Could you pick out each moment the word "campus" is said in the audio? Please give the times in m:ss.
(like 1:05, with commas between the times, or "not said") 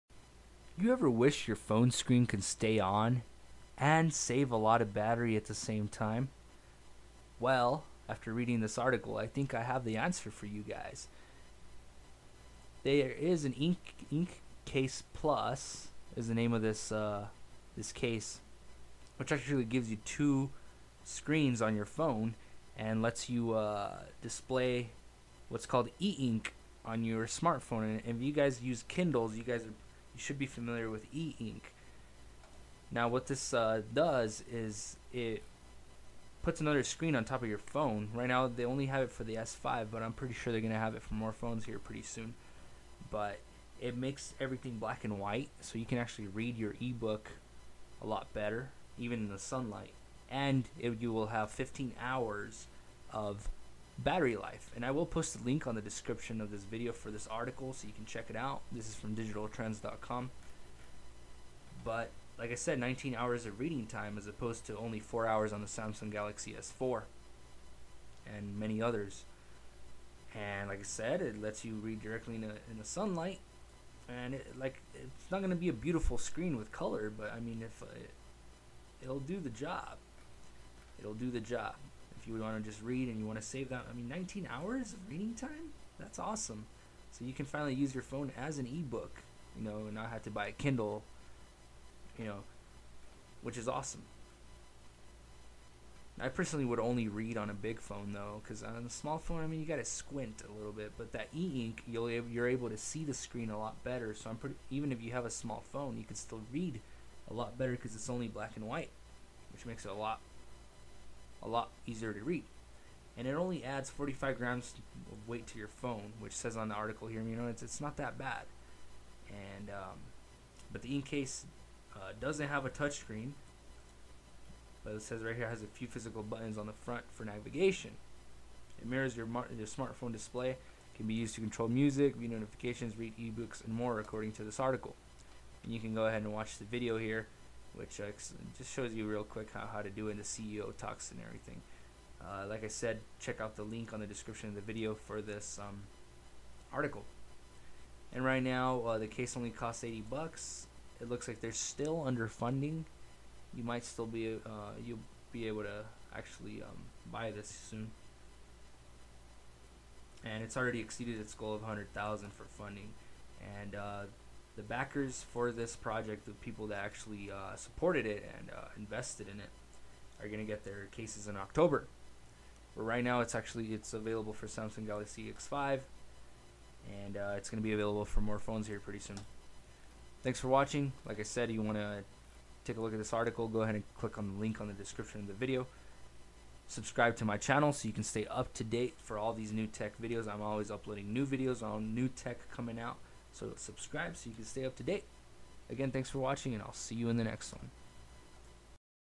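not said.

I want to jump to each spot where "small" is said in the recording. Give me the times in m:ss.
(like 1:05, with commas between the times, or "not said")
1:38, 1:45.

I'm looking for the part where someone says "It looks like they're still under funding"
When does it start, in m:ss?
2:30.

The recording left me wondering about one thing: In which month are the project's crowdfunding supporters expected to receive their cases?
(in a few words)
October.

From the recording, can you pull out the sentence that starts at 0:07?
Well, after reading this article, I think I have the answer for you guys.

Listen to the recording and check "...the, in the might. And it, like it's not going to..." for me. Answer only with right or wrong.
wrong.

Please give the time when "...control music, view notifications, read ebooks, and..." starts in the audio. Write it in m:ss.
2:11.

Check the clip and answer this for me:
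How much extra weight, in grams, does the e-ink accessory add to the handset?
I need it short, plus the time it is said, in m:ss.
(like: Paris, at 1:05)
45 grams, at 1:53.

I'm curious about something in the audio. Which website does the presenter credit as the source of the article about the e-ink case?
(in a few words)
digitaltrends.com.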